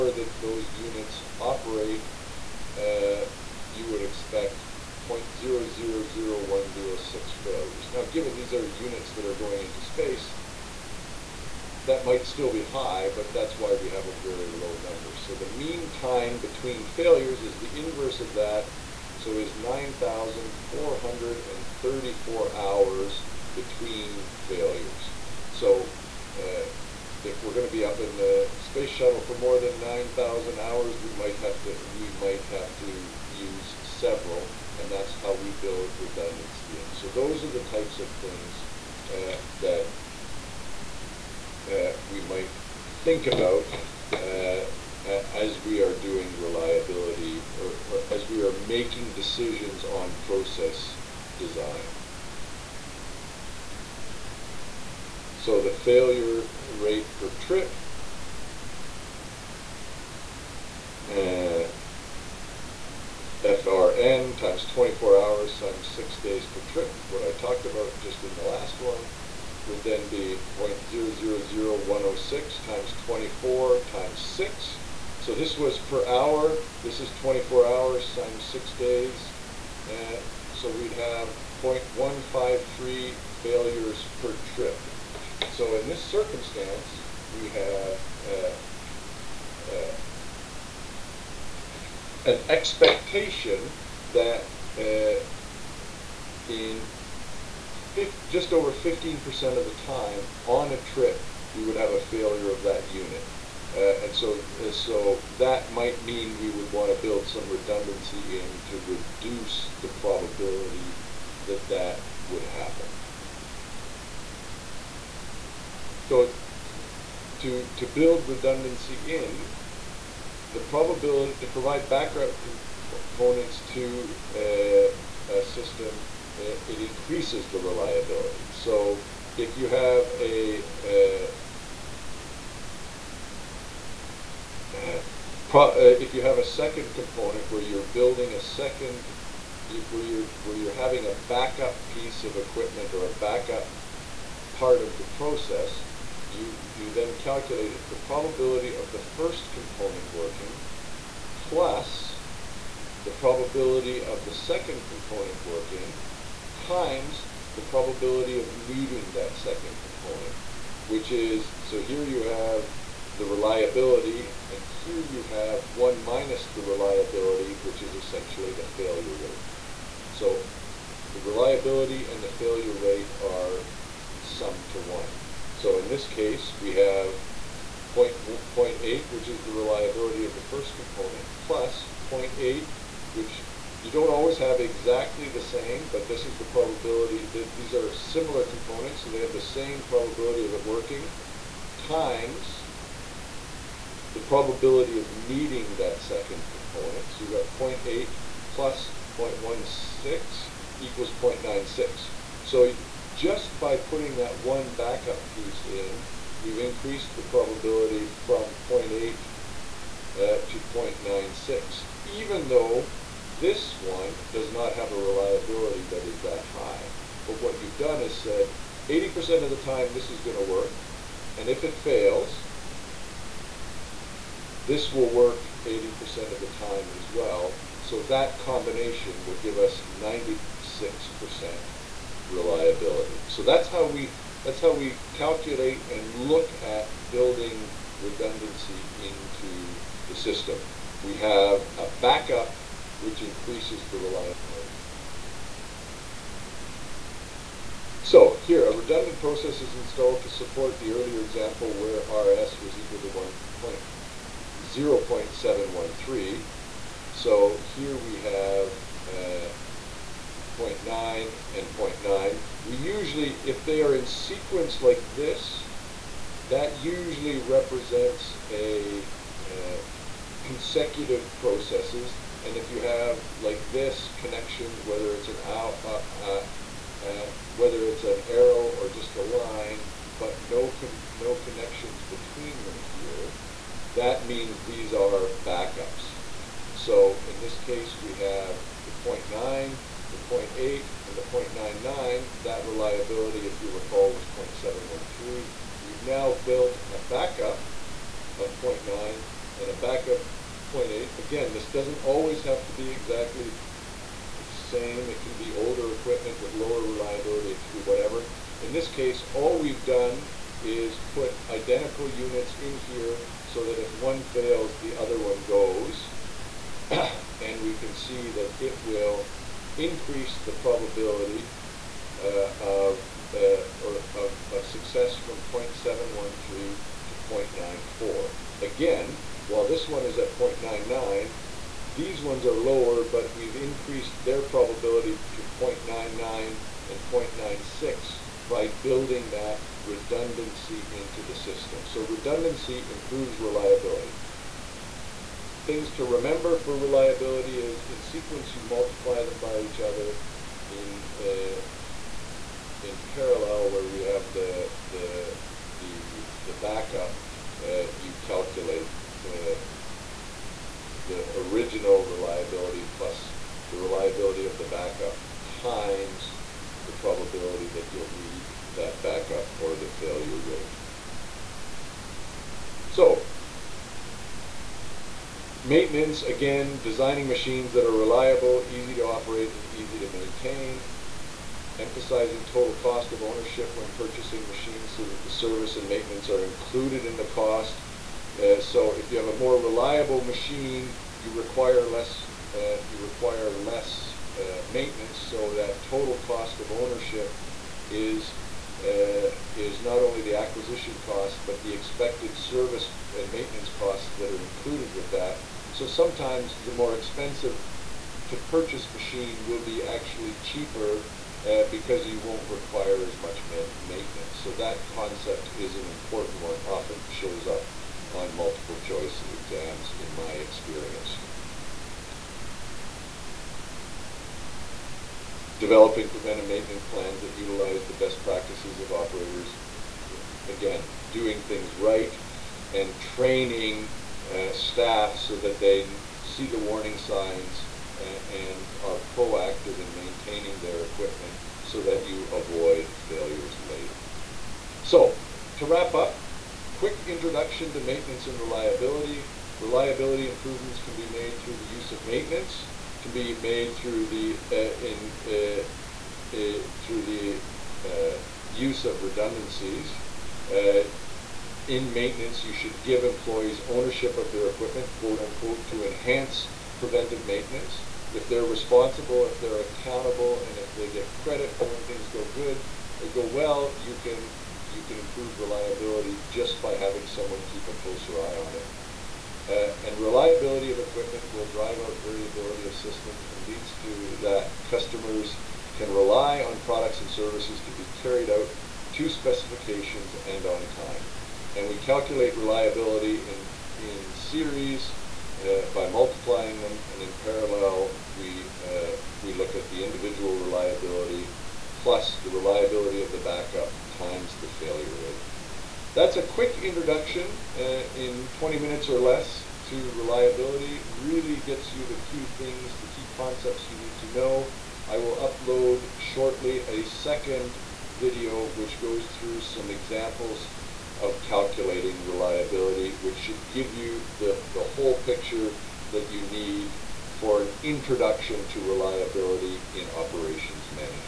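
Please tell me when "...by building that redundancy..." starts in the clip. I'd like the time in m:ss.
5:38.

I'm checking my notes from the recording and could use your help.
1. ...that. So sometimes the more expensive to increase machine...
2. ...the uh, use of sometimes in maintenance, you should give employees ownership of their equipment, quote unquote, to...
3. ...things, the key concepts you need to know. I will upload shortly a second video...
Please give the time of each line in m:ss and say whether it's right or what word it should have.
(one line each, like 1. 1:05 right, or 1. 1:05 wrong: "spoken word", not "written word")
1. 6:45 wrong: "purchase", not "increase"
2. 7:37 wrong: "redundancies", not "sometimes"
3. 8:32 right.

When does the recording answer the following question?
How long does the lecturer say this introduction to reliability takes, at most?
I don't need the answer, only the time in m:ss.
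8:28.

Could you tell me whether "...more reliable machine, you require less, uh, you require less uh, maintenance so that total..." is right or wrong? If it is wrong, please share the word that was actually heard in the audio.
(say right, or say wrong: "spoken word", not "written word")
right.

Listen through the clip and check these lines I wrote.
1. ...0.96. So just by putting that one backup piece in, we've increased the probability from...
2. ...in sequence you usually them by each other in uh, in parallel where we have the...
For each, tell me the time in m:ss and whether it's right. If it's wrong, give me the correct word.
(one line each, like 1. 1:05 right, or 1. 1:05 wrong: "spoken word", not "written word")
1. 3:21 right
2. 5:47 wrong: "multiply", not "usually".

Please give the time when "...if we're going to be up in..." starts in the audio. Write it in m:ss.
0:27.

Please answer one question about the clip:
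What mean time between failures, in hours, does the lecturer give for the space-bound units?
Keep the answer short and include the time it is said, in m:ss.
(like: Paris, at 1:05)
9,434 hours, at 0:19.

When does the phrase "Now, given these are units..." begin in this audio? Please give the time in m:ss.
0:07.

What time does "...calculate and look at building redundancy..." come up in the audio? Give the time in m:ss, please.
3:55.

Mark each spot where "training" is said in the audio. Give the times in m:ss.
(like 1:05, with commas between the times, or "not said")
7:12.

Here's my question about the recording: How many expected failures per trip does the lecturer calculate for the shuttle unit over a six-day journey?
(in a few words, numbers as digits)
0.153.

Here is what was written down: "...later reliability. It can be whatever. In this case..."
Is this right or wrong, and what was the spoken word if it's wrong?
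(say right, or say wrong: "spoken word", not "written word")
wrong: "lower", not "later".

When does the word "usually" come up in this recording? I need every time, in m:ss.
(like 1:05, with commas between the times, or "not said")
4:22, 4:26.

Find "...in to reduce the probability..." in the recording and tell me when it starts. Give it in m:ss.
1:48.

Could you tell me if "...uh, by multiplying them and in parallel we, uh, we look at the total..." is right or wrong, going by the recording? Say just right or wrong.
wrong.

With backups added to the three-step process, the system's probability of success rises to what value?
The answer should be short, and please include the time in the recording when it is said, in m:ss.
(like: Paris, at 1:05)
0.94, at 5:27.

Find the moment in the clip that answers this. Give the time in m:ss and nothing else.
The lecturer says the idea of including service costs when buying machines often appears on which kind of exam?
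6:58.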